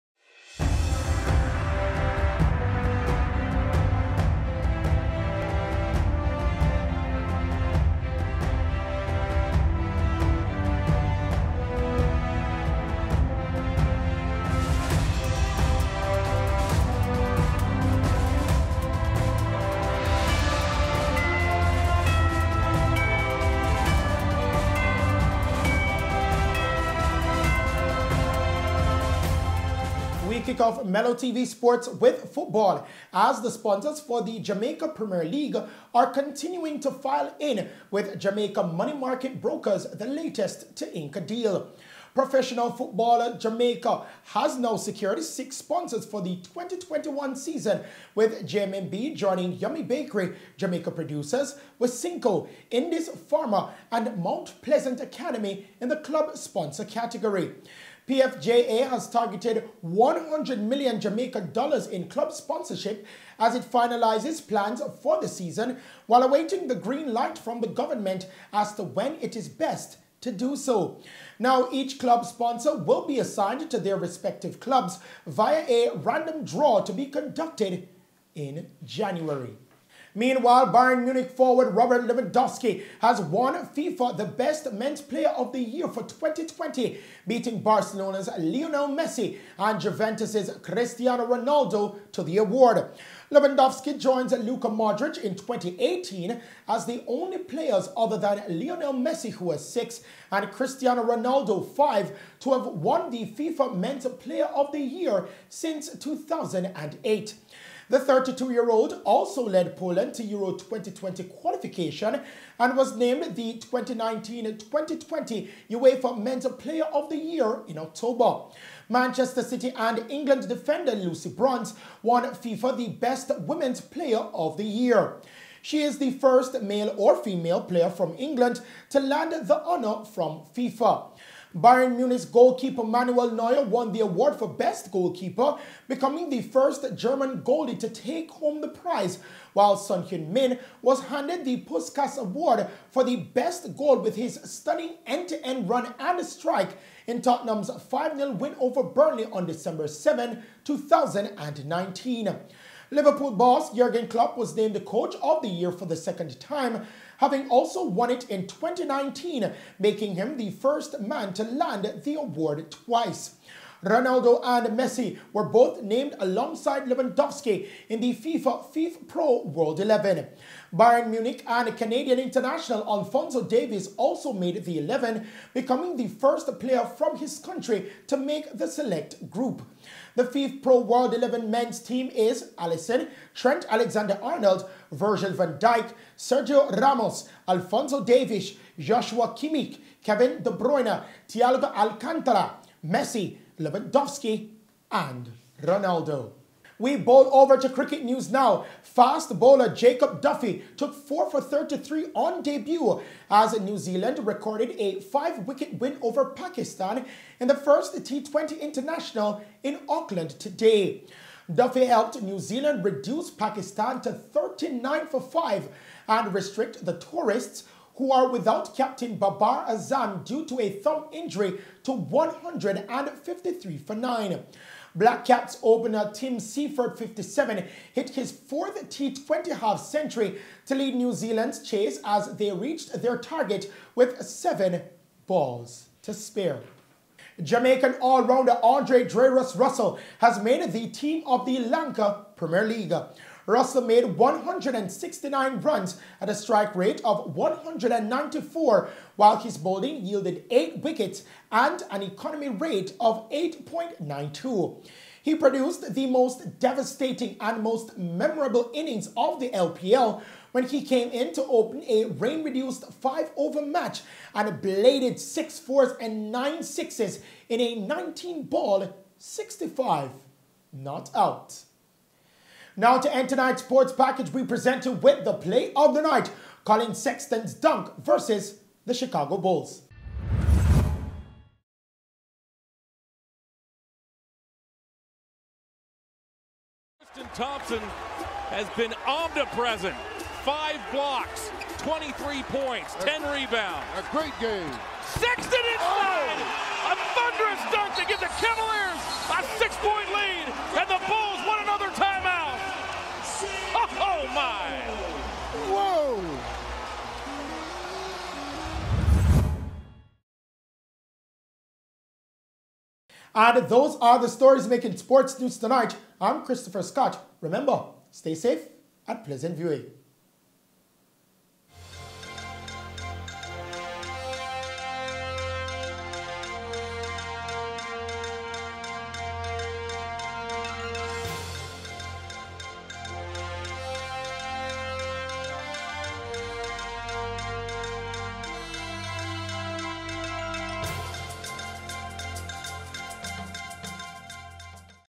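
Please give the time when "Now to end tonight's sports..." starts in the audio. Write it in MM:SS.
04:32.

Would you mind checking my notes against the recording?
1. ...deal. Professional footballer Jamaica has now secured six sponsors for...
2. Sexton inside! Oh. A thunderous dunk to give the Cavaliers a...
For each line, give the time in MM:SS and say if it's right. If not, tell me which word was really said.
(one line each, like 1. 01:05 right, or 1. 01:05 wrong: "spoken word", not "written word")
1. 00:41 right
2. 04:55 right.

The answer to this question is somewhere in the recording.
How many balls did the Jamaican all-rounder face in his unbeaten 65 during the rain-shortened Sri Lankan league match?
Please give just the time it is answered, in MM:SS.
04:27.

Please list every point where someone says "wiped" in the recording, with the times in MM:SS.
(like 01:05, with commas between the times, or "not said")
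not said.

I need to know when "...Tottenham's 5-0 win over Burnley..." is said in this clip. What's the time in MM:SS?
02:27.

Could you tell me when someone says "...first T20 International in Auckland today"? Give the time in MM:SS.
03:27.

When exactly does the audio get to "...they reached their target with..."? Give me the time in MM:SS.
03:52.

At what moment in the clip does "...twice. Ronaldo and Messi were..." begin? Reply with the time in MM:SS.
02:42.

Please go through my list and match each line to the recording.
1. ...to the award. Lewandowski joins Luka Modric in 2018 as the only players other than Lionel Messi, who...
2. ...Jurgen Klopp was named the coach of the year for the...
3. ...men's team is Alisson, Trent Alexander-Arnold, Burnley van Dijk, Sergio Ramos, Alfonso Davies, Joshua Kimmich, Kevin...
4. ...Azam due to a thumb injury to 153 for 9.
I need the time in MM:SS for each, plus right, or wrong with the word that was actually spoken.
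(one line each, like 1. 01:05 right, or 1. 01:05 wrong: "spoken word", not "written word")
1. 01:32 right
2. 02:33 right
3. 03:01 wrong: "Virgil", not "Burnley"
4. 03:39 right.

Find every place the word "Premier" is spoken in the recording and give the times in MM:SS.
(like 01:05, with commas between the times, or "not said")
00:34, 04:02.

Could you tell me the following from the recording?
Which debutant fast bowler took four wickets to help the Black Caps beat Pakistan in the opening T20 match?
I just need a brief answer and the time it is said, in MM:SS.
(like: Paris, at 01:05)
Jacob Duffy, at 03:19.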